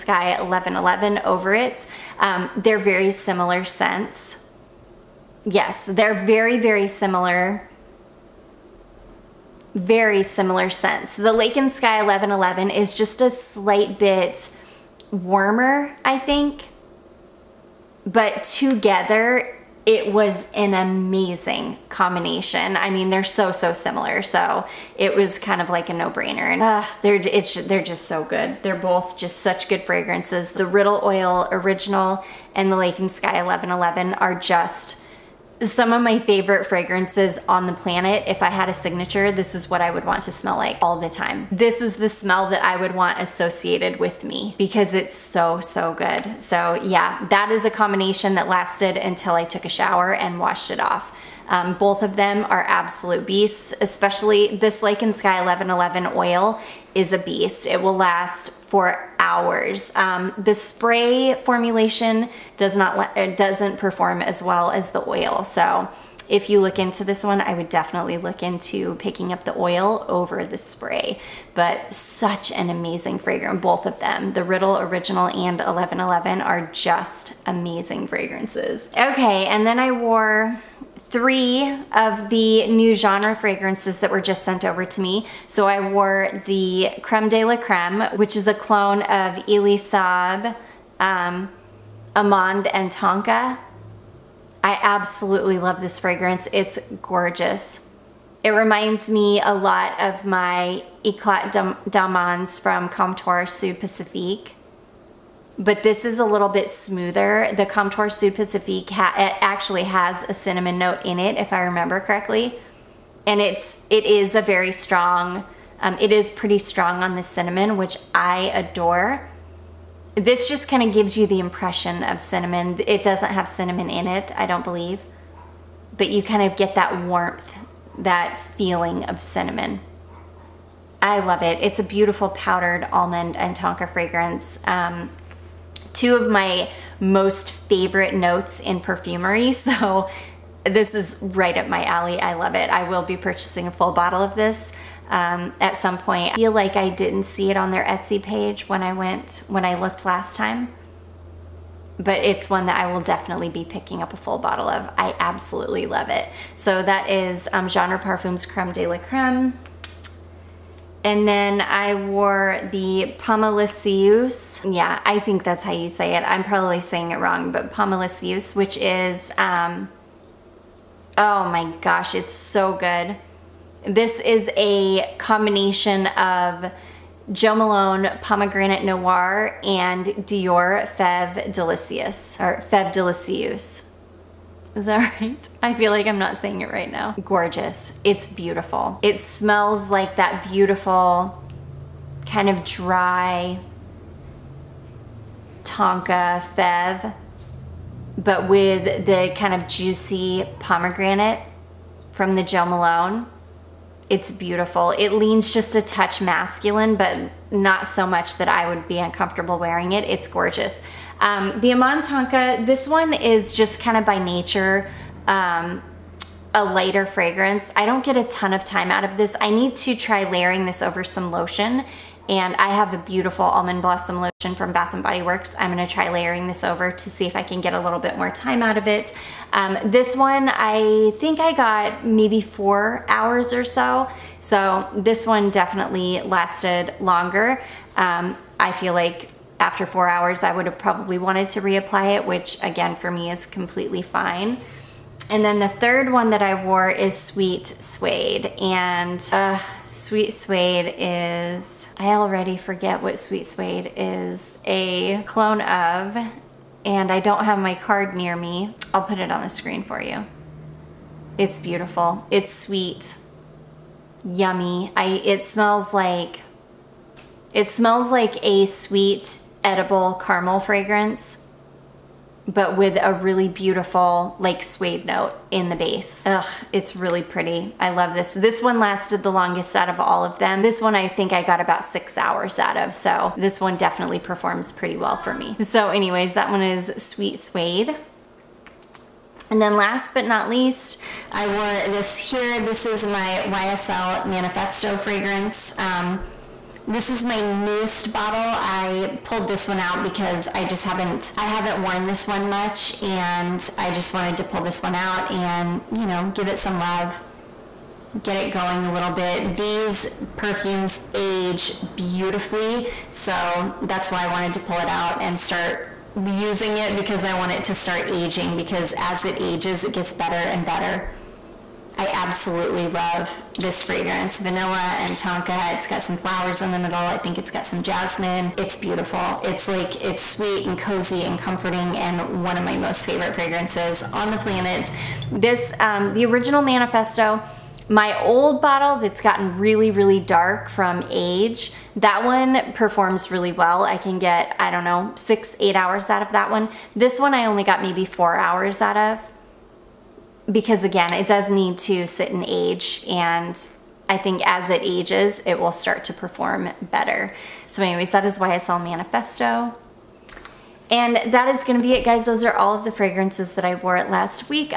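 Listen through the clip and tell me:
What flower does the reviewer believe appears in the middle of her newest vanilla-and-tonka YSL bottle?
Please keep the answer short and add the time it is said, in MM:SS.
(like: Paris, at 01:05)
Jasmine, at 05:27.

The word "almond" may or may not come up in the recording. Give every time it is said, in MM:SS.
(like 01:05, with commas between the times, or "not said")
02:12, 03:43.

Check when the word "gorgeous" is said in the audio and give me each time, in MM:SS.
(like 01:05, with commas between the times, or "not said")
01:37, 03:07, 03:30.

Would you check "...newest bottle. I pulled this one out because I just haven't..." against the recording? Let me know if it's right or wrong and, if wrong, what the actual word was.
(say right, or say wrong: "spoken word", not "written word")
right.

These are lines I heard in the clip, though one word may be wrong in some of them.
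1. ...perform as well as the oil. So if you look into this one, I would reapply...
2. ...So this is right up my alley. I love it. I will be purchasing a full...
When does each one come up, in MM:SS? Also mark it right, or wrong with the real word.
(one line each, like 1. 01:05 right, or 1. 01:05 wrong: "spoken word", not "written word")
1. 01:03 wrong: "definitely", not "reapply"
2. 02:19 right.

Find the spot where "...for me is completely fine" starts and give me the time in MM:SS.
04:02.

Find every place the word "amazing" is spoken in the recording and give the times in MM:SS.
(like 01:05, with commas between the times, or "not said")
00:20, 01:12, 01:17.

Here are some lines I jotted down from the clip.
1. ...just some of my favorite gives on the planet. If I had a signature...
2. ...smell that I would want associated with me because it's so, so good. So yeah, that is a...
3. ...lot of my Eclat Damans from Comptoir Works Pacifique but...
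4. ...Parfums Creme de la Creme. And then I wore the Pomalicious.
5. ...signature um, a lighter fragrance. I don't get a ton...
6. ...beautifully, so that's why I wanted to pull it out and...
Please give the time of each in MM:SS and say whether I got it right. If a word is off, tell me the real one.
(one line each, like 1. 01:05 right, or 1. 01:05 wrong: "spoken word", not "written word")
1. 00:34 wrong: "fragrances", not "gives"
2. 00:42 right
3. 01:39 wrong: "Sud", not "Works"
4. 02:37 right
5. 03:34 wrong: "nature", not "signature"
6. 05:11 right.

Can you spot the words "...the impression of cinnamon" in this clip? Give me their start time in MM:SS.
02:01.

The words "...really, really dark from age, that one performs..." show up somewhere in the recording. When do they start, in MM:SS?
05:39.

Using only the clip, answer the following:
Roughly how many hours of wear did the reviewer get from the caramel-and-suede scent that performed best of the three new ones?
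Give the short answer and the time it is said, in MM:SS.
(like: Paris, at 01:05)
6, at 04:41.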